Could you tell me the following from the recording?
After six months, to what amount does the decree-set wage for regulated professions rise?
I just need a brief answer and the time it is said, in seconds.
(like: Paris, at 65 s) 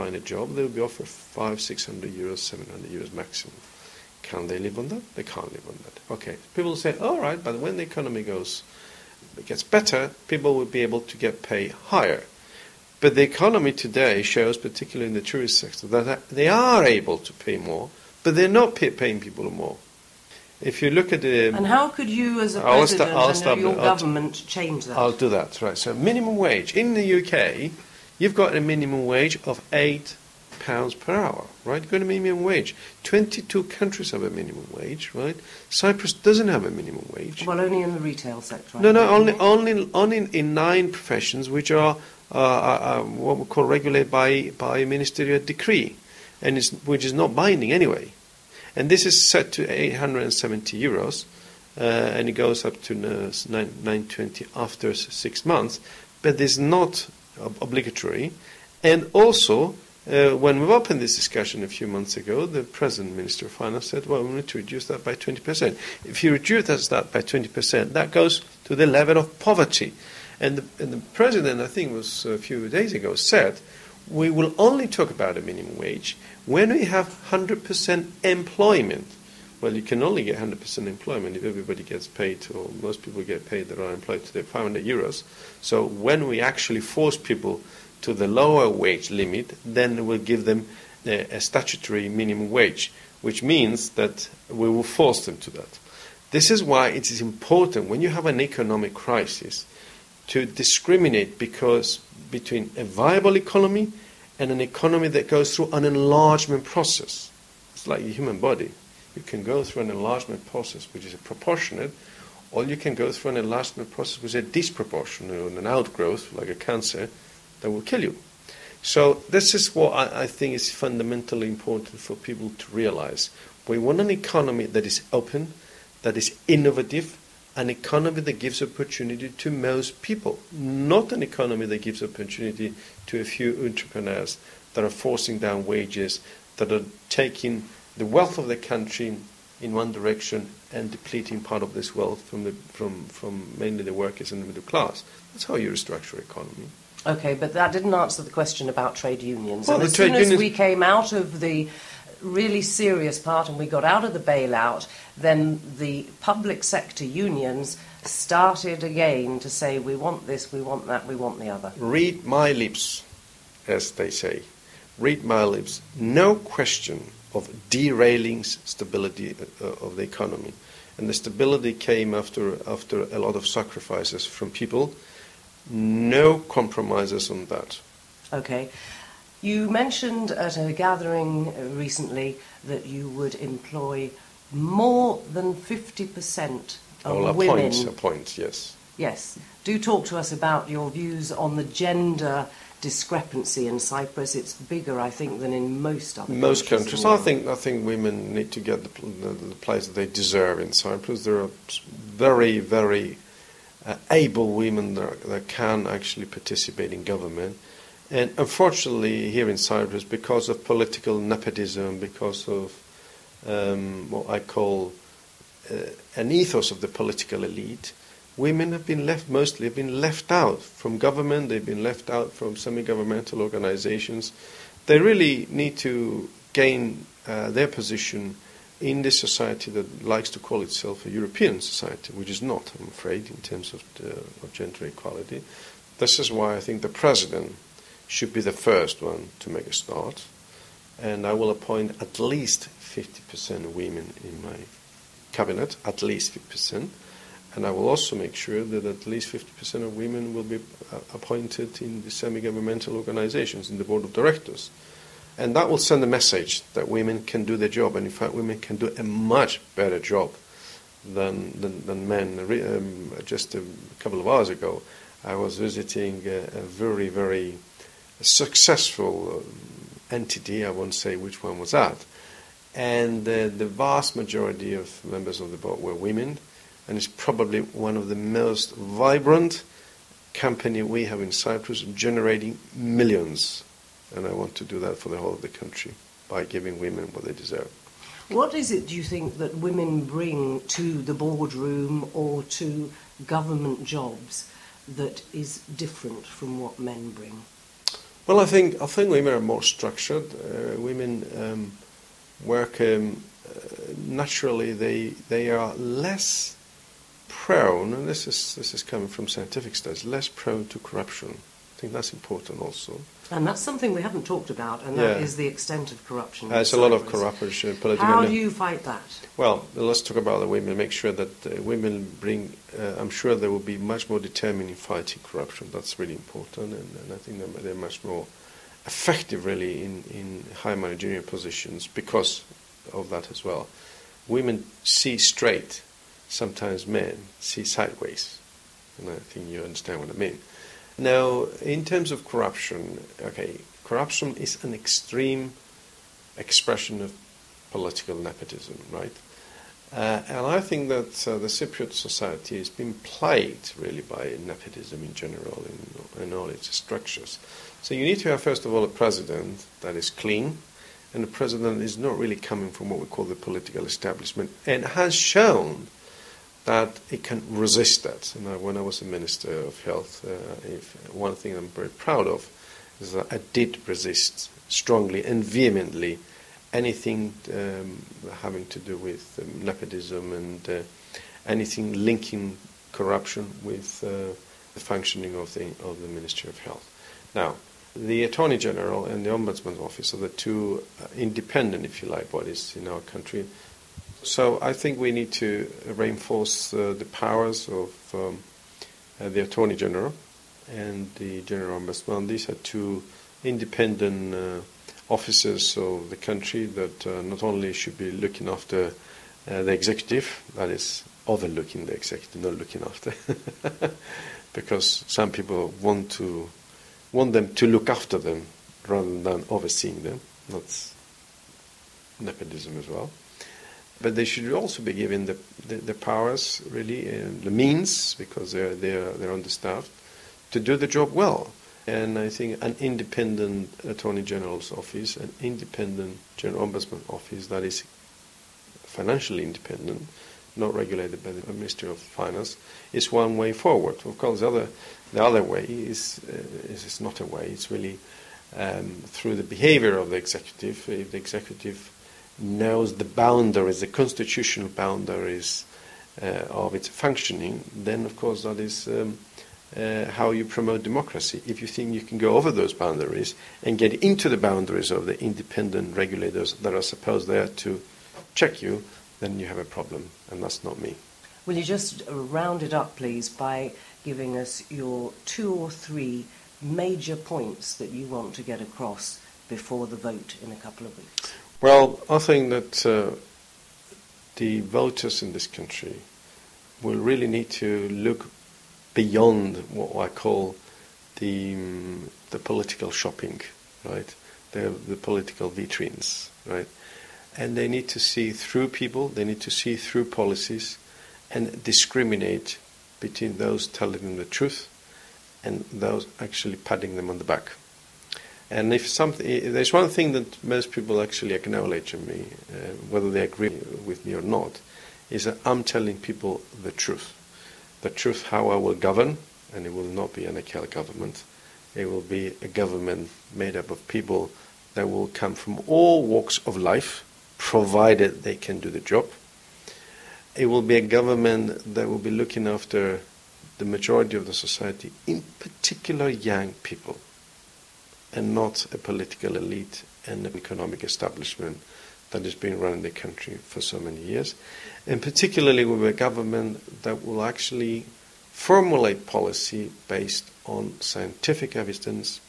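920 euros, at 53 s.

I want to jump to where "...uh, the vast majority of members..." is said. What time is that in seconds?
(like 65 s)
273 s.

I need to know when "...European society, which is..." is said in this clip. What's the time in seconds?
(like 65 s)
231 s.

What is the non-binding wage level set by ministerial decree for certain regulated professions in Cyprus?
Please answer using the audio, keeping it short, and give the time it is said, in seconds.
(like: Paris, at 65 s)
870 euros, at 49 s.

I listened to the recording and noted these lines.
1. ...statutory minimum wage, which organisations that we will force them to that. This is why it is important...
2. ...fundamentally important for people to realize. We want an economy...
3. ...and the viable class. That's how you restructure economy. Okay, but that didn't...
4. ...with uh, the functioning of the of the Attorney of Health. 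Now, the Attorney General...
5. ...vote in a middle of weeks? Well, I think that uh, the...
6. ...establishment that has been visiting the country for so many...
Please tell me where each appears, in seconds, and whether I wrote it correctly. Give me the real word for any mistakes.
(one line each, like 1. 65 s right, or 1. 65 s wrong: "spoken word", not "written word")
1. 91 s wrong: "means", not "organisations"
2. 120 s right
3. 144 s wrong: "middle", not "viable"
4. 383 s wrong: "Ministry", not "Attorney"
5. 479 s wrong: "couple", not "middle"
6. 540 s wrong: "running", not "visiting".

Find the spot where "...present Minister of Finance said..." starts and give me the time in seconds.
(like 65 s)
62 s.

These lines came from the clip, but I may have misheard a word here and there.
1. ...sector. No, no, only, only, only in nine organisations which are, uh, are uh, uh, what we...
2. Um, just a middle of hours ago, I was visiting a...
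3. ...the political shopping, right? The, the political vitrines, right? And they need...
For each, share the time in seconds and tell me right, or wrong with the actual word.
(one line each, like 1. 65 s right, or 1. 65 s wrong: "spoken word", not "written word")
1. 38 s wrong: "professions", not "organisations"
2. 262 s wrong: "couple", not "middle"
3. 492 s right.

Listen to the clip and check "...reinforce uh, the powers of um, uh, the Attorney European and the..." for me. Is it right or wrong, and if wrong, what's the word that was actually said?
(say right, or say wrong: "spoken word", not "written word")
wrong: "General", not "European".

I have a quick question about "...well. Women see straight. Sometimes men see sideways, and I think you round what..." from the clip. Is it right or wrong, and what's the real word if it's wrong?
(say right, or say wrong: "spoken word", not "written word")
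wrong: "understand", not "round".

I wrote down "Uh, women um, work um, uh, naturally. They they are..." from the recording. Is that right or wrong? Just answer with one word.
right.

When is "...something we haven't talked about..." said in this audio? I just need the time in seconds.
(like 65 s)
313 s.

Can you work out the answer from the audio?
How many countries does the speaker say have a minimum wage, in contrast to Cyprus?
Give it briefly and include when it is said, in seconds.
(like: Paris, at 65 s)
22, at 33 s.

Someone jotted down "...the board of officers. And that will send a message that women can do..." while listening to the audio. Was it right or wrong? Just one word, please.
wrong.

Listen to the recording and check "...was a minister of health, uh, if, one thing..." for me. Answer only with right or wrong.
right.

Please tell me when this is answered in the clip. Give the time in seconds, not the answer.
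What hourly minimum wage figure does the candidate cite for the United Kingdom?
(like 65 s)
29 s.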